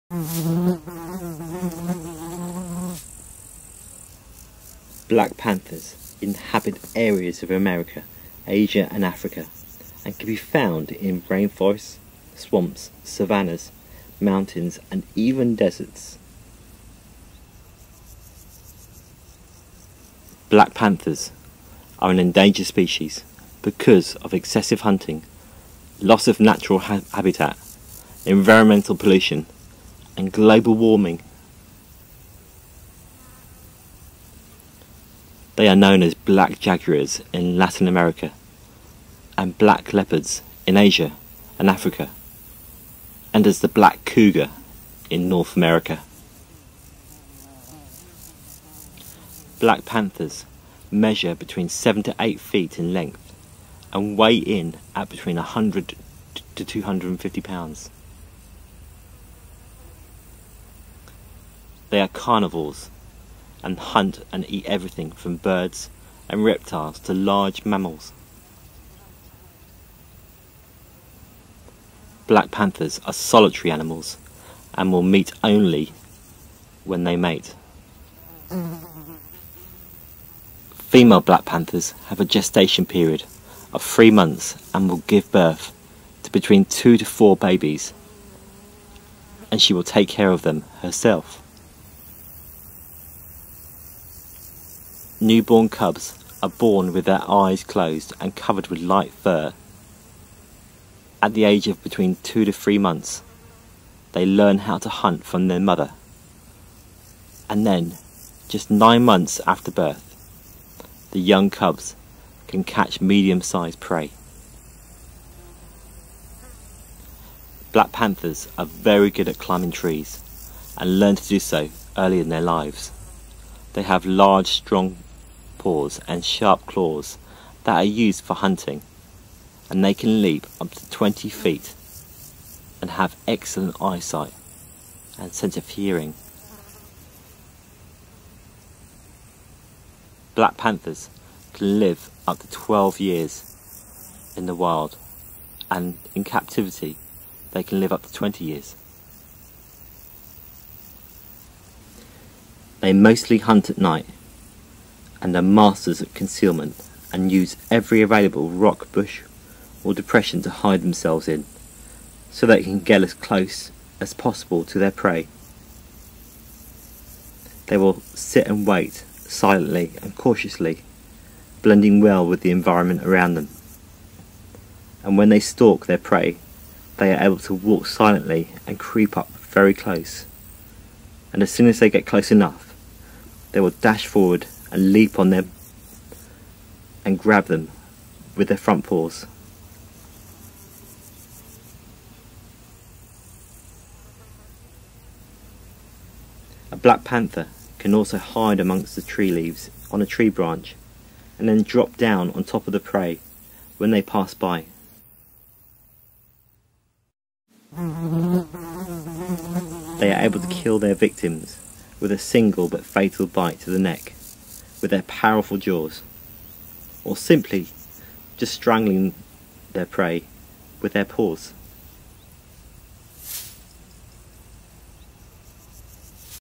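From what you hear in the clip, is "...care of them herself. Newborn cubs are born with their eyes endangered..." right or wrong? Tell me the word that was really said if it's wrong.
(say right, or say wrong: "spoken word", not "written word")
wrong: "closed", not "endangered".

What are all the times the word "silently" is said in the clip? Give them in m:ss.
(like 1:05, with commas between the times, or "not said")
2:49, 2:57.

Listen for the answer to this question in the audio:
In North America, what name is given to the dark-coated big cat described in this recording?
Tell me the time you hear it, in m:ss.
0:43.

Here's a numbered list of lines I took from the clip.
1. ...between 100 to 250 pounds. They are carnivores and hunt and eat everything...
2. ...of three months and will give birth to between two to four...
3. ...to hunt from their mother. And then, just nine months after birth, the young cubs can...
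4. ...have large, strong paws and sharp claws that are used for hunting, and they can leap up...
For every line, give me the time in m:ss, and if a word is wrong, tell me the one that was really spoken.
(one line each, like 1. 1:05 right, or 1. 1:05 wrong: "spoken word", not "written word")
1. 0:55 right
2. 1:23 right
3. 1:44 right
4. 2:03 right.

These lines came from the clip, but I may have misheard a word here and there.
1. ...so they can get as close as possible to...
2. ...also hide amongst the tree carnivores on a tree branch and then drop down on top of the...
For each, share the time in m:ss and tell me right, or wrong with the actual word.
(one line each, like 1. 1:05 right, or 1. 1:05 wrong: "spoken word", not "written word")
1. 2:42 right
2. 3:17 wrong: "leaves", not "carnivores".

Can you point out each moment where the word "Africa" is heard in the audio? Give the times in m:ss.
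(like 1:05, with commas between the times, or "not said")
0:09, 0:41.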